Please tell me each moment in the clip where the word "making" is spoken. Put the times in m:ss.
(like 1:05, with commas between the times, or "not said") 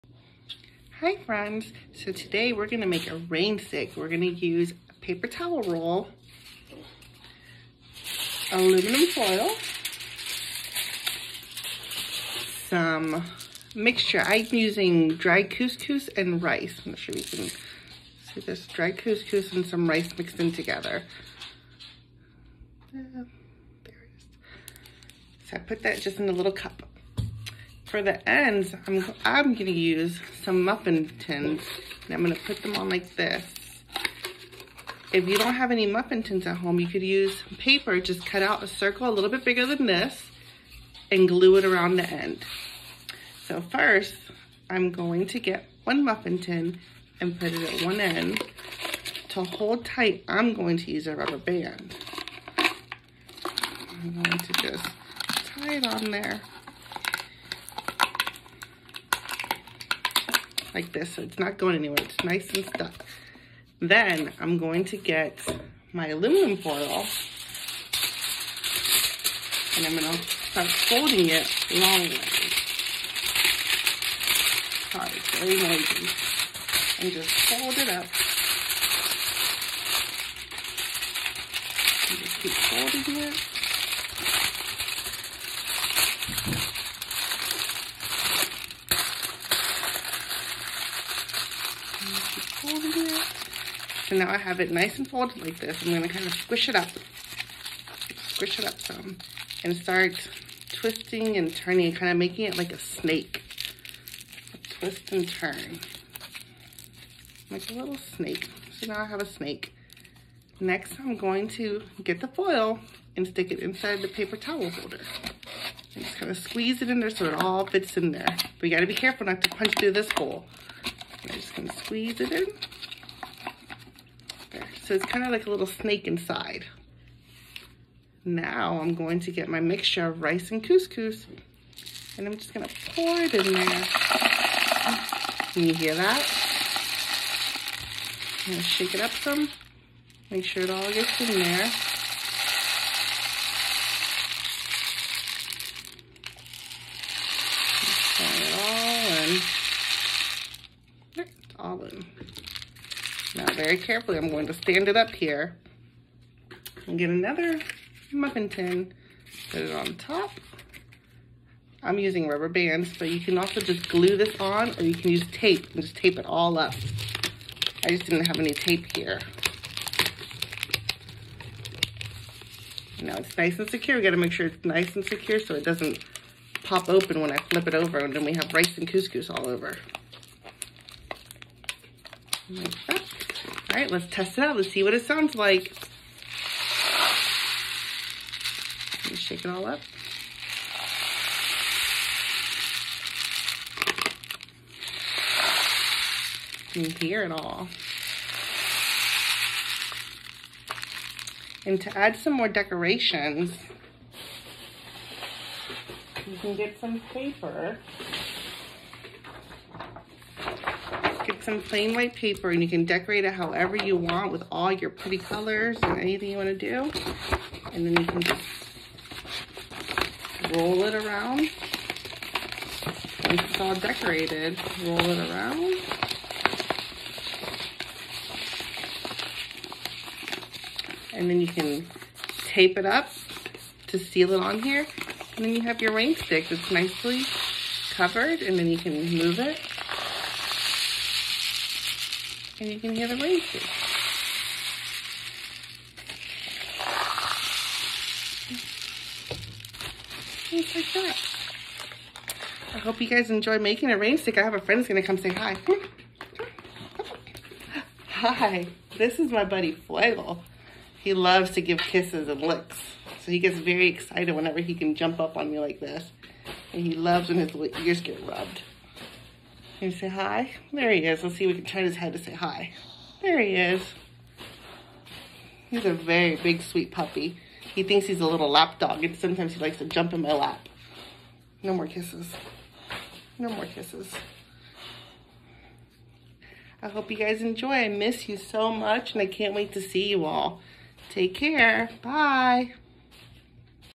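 1:42, 4:13.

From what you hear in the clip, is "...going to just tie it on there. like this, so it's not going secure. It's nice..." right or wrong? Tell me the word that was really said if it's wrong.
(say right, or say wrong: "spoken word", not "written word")
wrong: "anywhere", not "secure".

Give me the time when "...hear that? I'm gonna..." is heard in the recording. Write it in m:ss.
2:15.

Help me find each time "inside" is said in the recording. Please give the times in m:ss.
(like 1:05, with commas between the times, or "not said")
1:53, 2:06.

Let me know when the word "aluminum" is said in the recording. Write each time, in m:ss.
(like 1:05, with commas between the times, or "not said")
0:08, 1:06.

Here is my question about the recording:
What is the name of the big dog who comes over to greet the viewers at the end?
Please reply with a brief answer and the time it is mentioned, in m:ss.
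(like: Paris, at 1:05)
Fuego, at 4:19.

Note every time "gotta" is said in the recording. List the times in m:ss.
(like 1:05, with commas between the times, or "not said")
1:58, 2:54.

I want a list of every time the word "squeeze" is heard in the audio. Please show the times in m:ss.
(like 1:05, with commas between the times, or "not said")
1:56, 2:01.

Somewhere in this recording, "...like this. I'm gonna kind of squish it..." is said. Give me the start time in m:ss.
1:35.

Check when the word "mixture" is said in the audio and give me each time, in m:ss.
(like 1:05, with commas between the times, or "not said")
0:13, 2:09.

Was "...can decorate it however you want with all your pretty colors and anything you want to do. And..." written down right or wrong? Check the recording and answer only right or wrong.
right.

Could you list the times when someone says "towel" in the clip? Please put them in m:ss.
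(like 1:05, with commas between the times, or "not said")
0:05, 1:54.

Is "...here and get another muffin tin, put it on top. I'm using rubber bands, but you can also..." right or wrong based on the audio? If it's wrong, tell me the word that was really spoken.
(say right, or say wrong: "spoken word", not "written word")
right.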